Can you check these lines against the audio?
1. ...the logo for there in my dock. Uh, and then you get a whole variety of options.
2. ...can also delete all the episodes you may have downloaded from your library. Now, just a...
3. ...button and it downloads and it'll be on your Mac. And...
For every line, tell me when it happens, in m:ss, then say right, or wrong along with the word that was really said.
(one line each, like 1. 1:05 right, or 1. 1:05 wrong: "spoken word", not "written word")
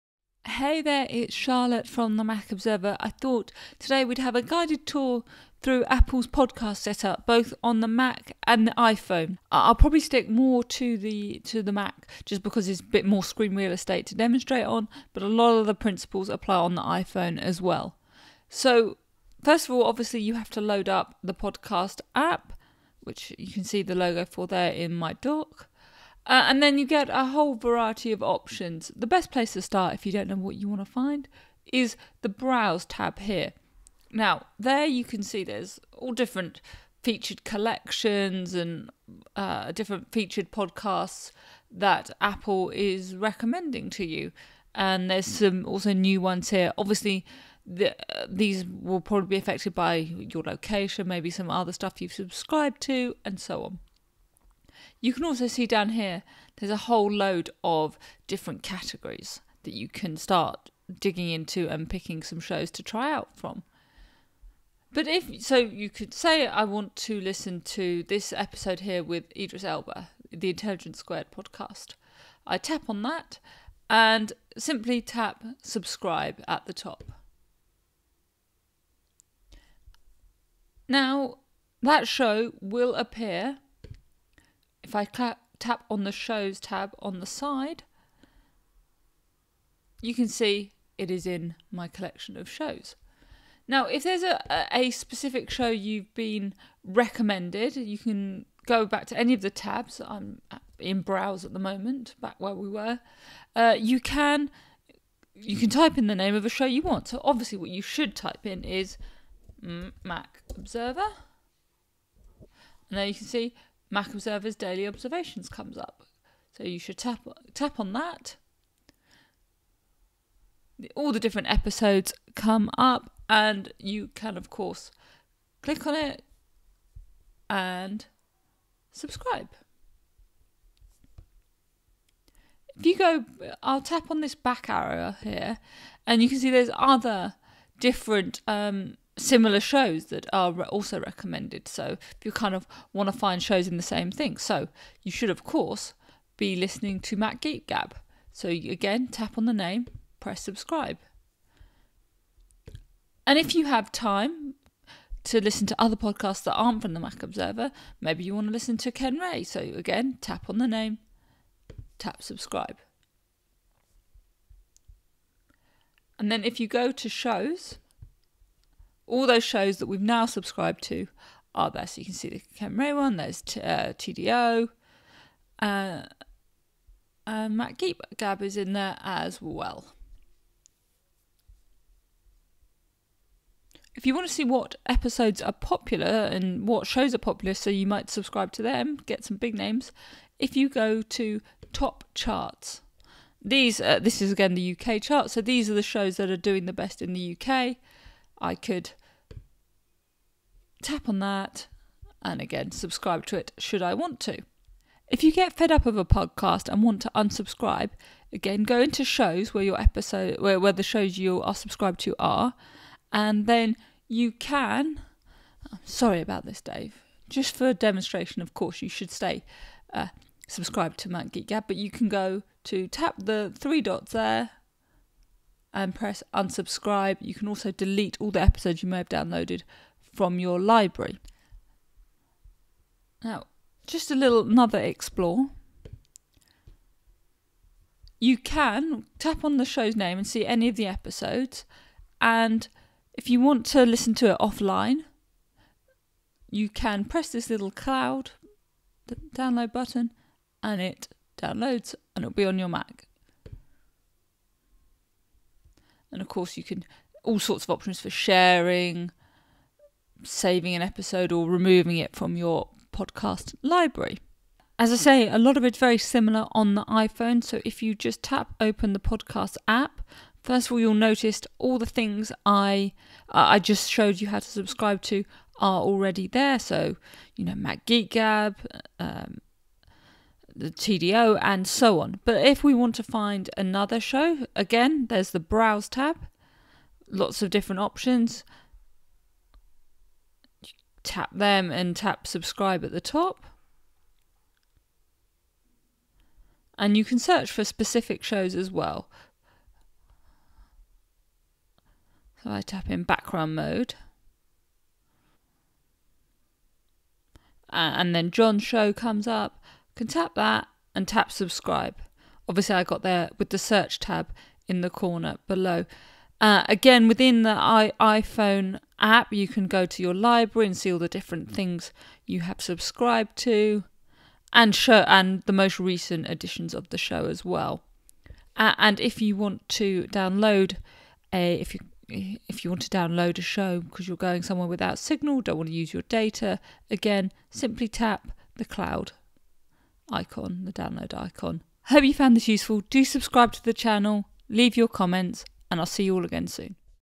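1. 0:23 right
2. 3:47 right
3. 4:09 right.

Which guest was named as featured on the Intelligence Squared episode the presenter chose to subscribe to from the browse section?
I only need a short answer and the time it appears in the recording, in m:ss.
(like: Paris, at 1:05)
Idris Elba, at 1:09.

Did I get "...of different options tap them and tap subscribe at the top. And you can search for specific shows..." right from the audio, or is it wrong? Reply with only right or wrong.
right.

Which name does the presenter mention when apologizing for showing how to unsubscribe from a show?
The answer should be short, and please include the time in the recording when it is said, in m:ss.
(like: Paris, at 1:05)
Dave, at 3:36.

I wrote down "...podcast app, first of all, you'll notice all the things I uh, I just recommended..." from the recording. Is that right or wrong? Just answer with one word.
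wrong.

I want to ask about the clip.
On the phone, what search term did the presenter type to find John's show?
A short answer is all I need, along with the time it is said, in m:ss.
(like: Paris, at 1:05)
background mode, at 5:03.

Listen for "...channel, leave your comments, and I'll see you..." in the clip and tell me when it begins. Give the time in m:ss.
5:43.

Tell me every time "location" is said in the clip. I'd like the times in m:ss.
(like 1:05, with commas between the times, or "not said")
0:50.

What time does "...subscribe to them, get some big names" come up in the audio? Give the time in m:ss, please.
3:08.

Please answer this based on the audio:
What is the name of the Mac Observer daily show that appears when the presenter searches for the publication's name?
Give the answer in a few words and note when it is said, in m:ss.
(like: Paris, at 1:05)
Daily Observations, at 1:54.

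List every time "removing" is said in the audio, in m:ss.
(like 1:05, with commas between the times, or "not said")
4:21.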